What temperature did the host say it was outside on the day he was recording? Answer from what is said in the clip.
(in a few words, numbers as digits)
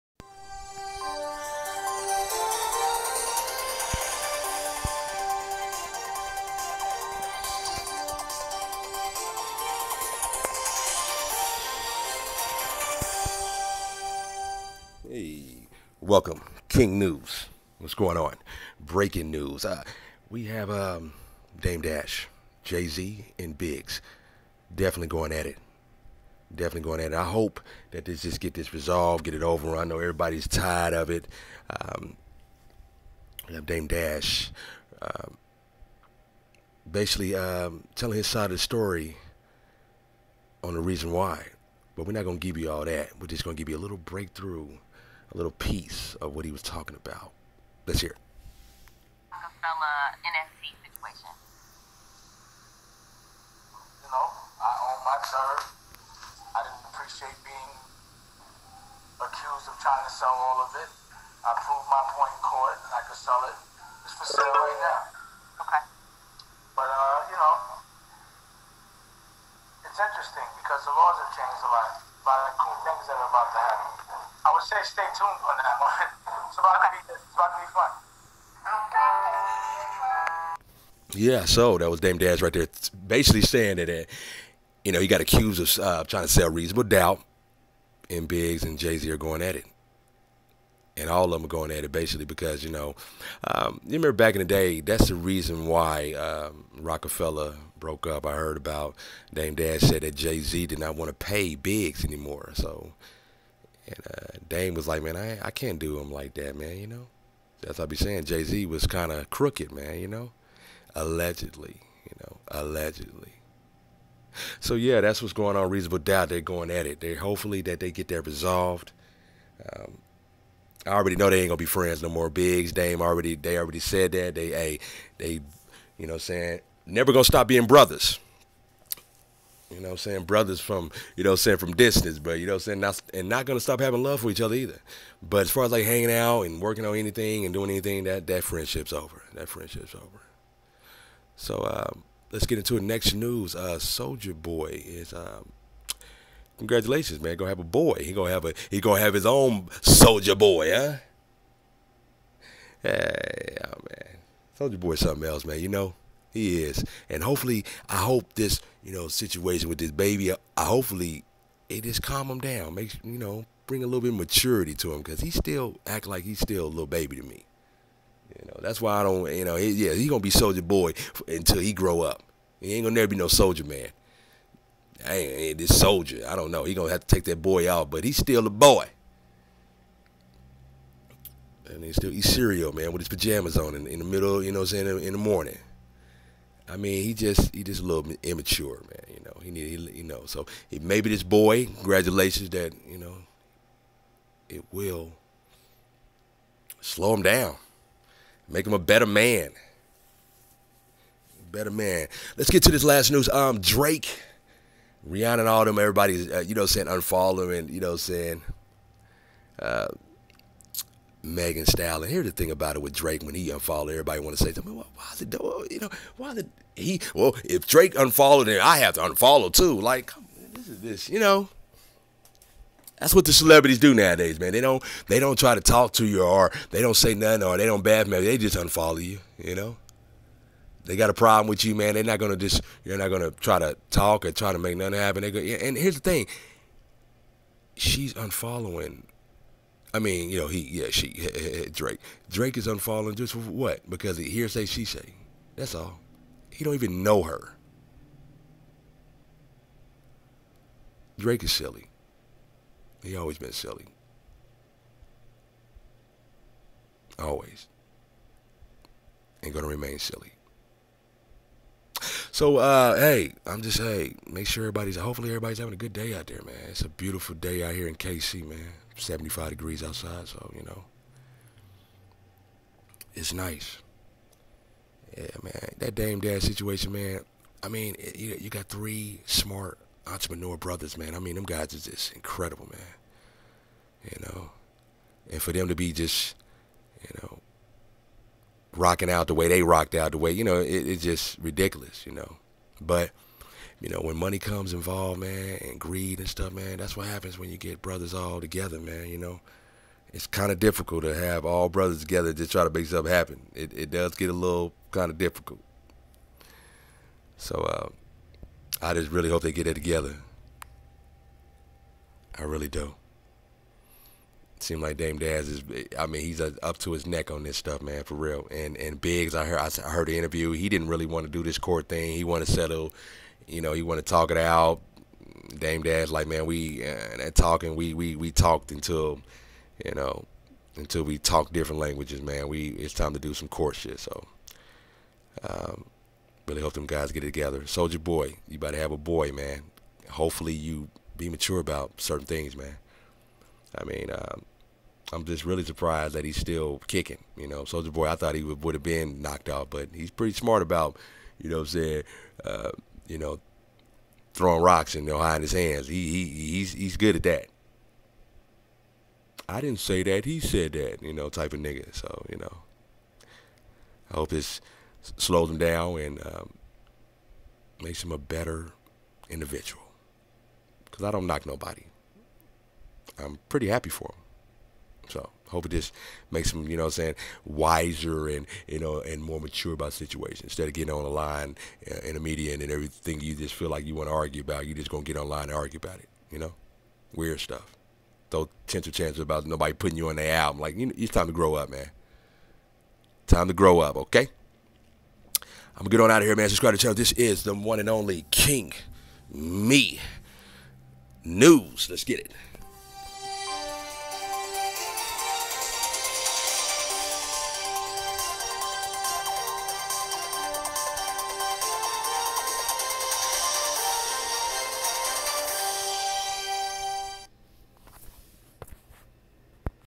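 75 degrees.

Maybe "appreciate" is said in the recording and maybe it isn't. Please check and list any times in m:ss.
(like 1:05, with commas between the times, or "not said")
0:56.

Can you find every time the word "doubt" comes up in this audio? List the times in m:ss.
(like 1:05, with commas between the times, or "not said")
1:26, 1:55.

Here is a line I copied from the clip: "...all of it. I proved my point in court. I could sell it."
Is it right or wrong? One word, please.
right.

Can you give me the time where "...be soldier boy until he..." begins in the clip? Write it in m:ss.
2:50.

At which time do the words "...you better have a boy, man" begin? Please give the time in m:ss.
5:38.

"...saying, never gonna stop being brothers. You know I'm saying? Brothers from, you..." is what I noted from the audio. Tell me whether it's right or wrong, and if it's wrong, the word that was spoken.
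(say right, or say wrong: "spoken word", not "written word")
right.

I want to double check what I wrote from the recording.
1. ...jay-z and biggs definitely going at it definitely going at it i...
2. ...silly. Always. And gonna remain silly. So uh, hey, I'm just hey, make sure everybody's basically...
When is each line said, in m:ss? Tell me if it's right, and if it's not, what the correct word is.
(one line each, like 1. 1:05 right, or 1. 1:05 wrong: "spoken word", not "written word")
1. 0:22 right
2. 4:13 wrong: "hopefully", not "basically".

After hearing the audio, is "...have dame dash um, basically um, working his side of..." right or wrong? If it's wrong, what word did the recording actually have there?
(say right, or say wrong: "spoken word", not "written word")
wrong: "telling", not "working".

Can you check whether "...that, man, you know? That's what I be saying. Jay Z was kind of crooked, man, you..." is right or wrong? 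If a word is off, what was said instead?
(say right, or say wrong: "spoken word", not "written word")
right.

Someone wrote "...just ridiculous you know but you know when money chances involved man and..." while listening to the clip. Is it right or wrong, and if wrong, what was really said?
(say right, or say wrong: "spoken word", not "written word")
wrong: "comes", not "chances".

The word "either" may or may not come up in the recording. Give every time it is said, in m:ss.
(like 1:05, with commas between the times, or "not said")
2:14.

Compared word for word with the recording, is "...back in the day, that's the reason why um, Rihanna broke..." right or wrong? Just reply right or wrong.
wrong.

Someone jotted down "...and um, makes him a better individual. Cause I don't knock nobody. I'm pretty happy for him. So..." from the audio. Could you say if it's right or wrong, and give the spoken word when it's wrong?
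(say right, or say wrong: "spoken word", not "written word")
right.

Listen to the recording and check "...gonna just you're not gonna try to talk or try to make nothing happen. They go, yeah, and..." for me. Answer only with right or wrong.
right.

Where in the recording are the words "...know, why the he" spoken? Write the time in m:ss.
3:35.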